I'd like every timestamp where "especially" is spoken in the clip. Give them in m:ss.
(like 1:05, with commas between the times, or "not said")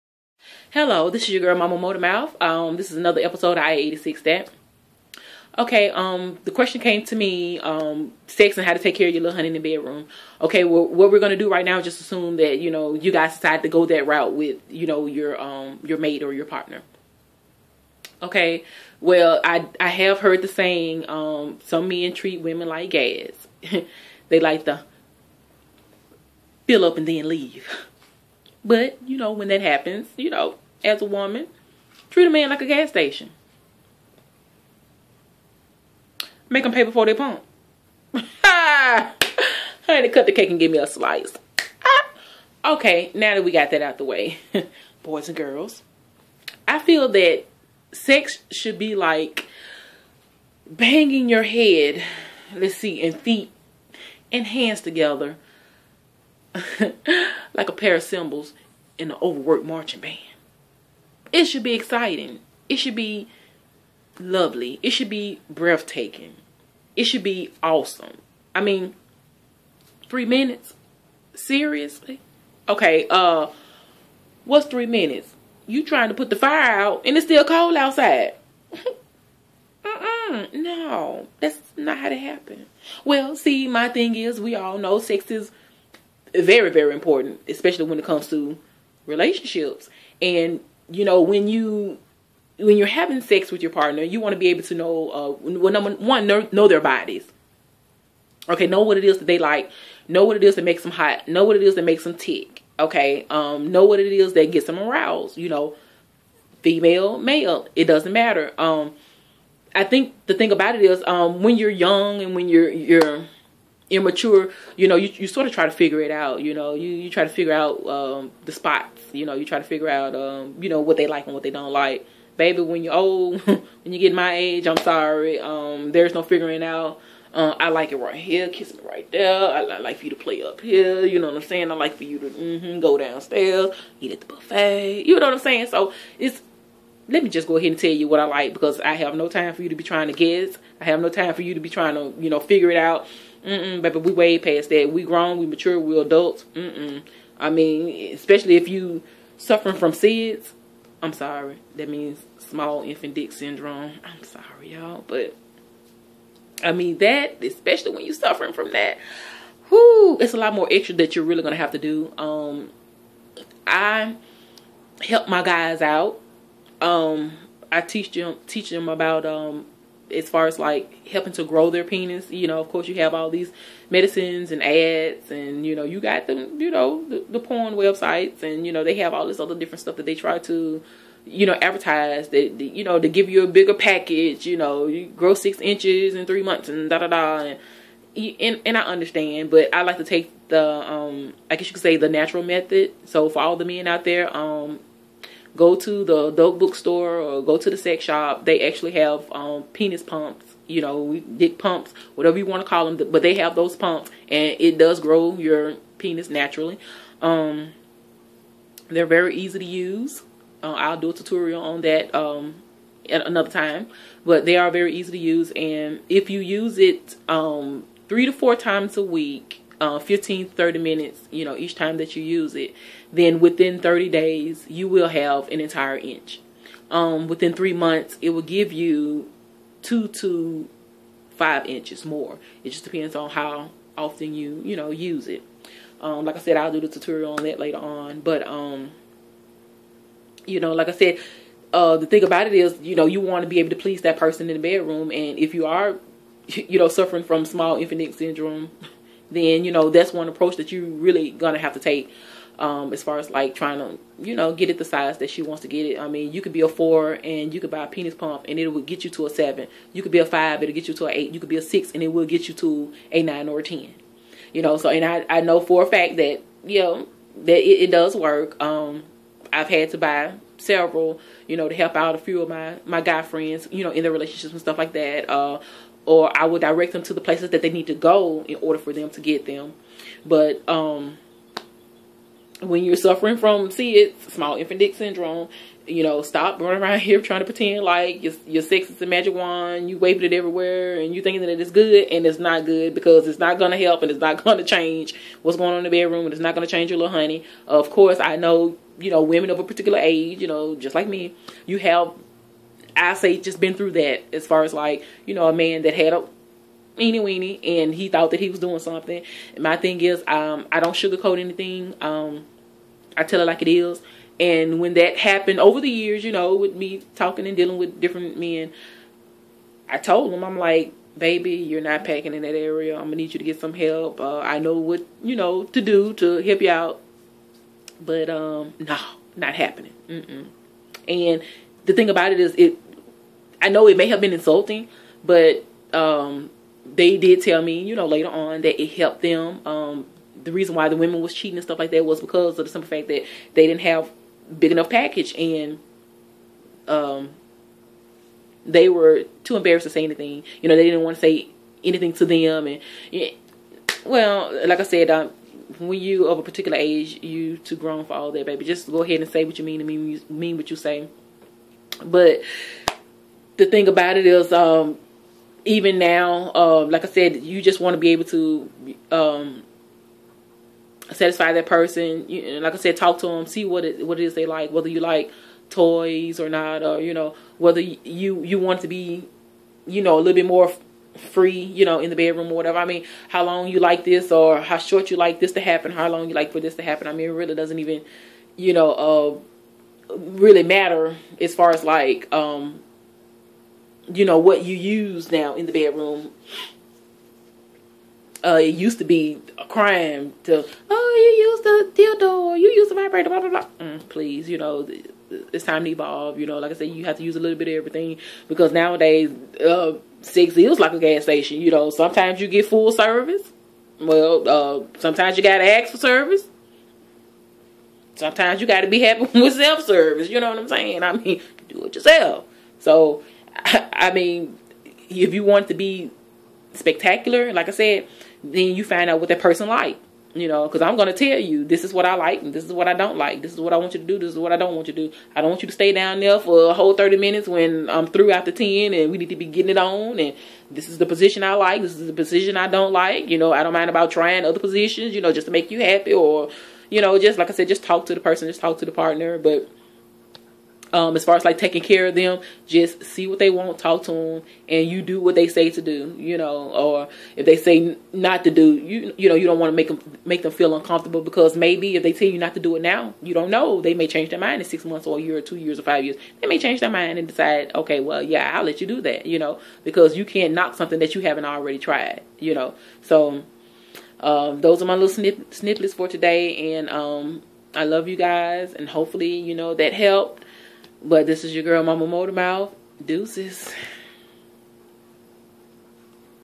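1:27, 2:28, 2:37.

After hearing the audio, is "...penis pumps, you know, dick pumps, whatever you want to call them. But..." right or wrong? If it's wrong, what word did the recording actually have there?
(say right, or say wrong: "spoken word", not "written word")
right.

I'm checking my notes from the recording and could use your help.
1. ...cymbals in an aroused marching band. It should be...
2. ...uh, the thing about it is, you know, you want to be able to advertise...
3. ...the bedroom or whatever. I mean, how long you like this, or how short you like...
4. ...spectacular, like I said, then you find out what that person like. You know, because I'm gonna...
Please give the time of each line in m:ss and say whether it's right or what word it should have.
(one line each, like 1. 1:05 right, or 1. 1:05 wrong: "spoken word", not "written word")
1. 0:58 wrong: "overworked", not "aroused"
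2. 4:01 wrong: "please", not "advertise"
3. 6:22 right
4. 7:06 right.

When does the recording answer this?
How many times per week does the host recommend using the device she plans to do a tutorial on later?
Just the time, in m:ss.
3:38.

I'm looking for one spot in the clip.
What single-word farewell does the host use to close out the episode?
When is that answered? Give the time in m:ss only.
8:03.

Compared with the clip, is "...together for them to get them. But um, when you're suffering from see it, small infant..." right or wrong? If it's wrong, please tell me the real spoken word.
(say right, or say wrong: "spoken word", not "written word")
wrong: "order", not "together".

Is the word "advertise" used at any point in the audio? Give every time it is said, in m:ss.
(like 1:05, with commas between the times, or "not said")
3:01.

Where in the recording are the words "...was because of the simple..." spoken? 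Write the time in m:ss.
5:42.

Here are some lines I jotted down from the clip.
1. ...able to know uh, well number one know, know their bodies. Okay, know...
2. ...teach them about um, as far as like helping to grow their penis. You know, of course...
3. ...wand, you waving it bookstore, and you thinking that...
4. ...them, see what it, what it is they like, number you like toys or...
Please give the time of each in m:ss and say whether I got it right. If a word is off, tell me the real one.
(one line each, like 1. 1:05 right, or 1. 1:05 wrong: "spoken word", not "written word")
1. 1:34 right
2. 2:48 right
3. 4:49 wrong: "everywhere", not "bookstore"
4. 6:13 wrong: "whether", not "number".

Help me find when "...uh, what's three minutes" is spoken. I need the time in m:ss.
1:13.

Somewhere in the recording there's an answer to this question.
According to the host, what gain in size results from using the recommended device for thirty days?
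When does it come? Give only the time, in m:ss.
3:45.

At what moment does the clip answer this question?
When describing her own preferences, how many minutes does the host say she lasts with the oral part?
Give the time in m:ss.
7:18.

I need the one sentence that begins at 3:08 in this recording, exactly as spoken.
And, and, and I understand, but I like to take the, um, I guess you could say the natural method.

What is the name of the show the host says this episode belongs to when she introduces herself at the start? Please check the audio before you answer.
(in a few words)
I-86 That.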